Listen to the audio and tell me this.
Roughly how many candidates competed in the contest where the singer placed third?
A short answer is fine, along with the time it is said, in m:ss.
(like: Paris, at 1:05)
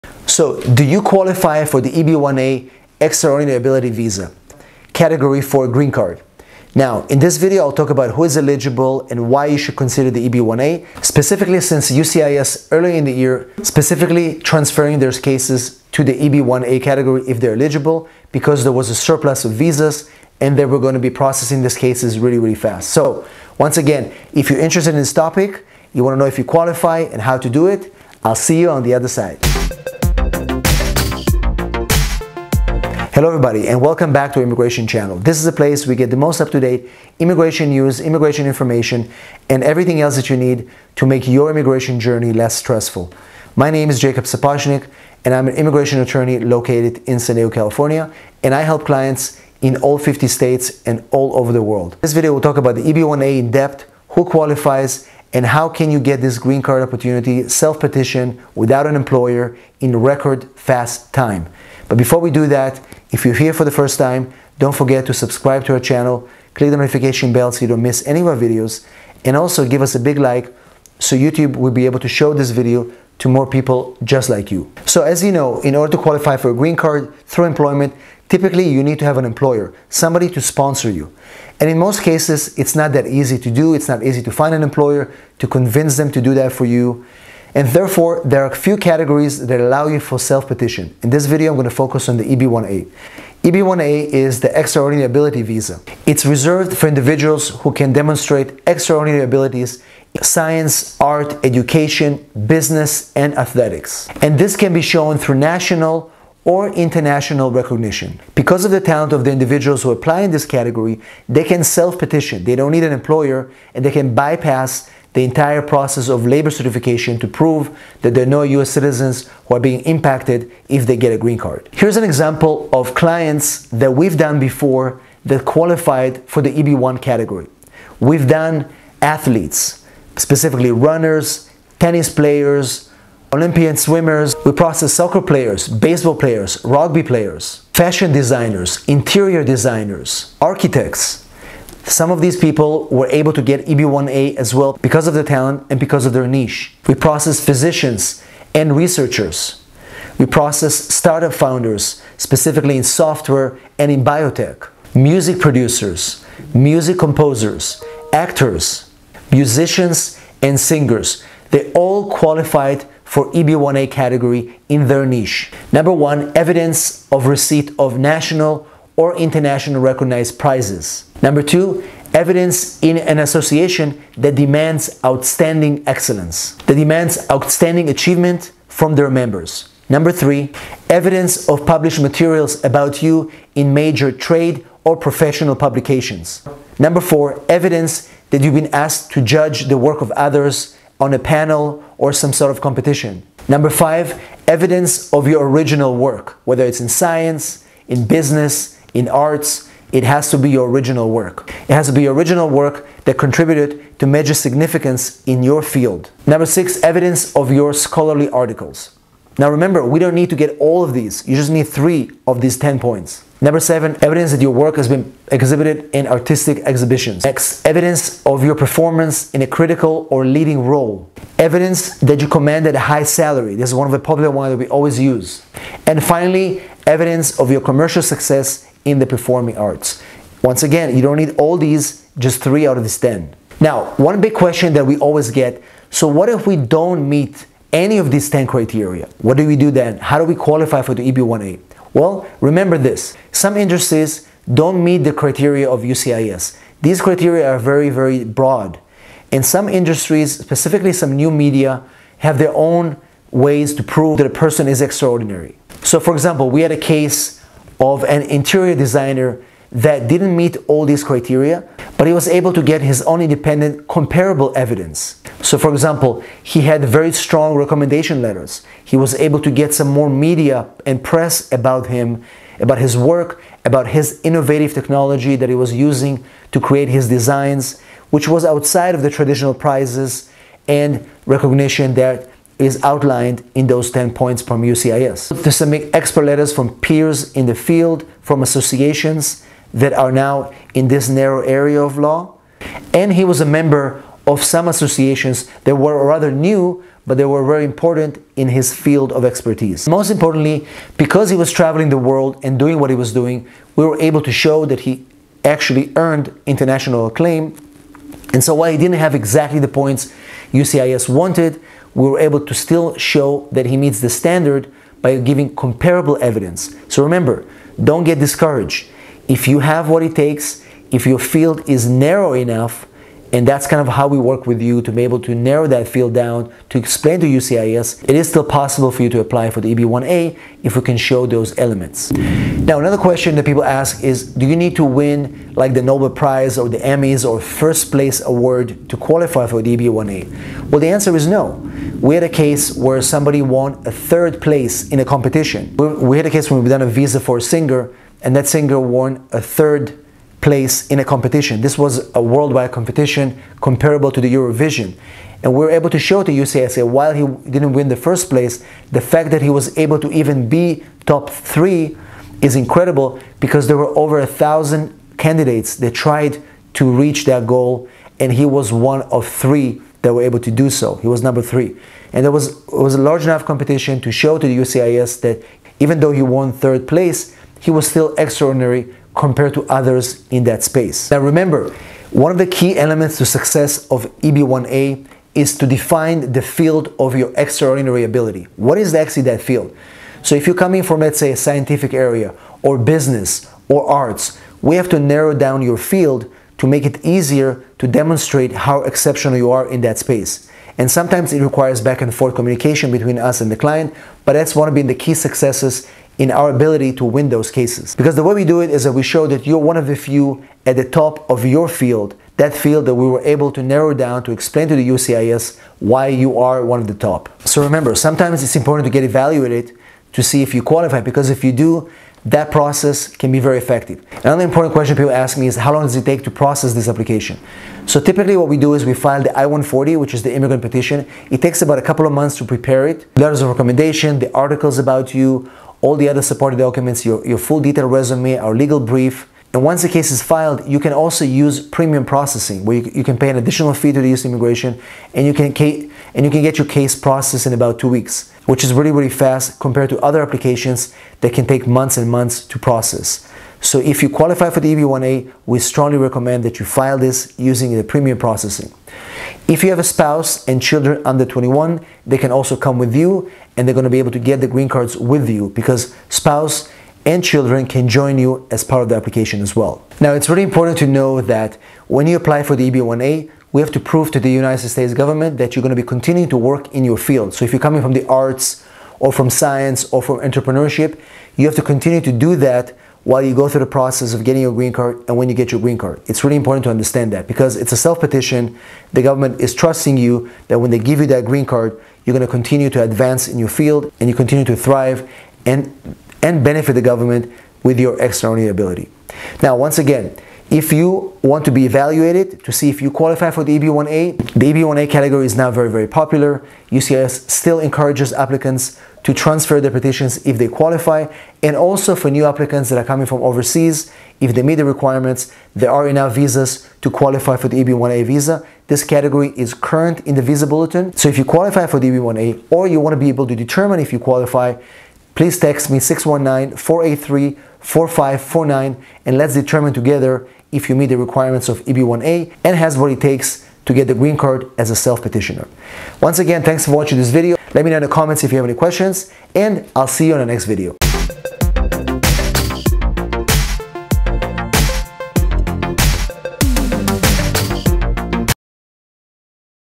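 Over 1000, at 6:03.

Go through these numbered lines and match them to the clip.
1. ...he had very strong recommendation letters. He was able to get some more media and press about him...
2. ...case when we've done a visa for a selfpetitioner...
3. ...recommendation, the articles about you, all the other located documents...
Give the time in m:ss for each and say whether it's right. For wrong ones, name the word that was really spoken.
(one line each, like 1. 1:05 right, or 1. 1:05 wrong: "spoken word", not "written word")
1. 4:26 right
2. 5:46 wrong: "singer", not "selfpetitioner"
3. 7:13 wrong: "supported", not "located".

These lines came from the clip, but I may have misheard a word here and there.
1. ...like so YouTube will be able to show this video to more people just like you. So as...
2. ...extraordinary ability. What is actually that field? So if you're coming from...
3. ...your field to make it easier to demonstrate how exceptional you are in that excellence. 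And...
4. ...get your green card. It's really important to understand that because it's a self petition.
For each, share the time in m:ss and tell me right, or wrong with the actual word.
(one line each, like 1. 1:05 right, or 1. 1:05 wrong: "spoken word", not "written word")
1. 1:10 right
2. 6:27 right
3. 6:35 wrong: "space", not "excellence"
4. 8:05 right.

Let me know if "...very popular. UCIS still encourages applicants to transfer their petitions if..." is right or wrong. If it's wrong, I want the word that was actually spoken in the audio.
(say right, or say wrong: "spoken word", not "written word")
right.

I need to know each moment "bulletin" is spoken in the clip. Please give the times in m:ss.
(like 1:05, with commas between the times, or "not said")
8:40.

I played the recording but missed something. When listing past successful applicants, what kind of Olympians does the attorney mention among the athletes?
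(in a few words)
Swimmers.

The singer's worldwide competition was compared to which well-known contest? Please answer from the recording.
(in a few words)
Eurovision.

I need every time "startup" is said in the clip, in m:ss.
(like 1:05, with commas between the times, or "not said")
2:30.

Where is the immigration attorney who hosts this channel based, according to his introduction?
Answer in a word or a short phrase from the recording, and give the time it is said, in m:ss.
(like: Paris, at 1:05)
San Diego, California, at 0:47.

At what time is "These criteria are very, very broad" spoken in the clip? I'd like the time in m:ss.
4:06.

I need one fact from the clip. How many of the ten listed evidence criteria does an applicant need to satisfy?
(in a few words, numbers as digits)
3.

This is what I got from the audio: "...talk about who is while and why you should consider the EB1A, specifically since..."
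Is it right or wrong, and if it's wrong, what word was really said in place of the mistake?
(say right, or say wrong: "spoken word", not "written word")
wrong: "eligible", not "while".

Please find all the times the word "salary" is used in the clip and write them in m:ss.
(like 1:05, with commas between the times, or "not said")
3:43.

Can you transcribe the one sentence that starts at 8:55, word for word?
Once again, thanks for watching this video.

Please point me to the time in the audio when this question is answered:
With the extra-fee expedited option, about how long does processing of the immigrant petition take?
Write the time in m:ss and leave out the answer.
7:27.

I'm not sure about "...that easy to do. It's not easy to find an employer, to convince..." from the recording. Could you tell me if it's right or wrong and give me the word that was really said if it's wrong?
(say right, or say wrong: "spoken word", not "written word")
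right.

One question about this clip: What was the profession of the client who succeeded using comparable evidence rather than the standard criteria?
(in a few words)
Interior designer.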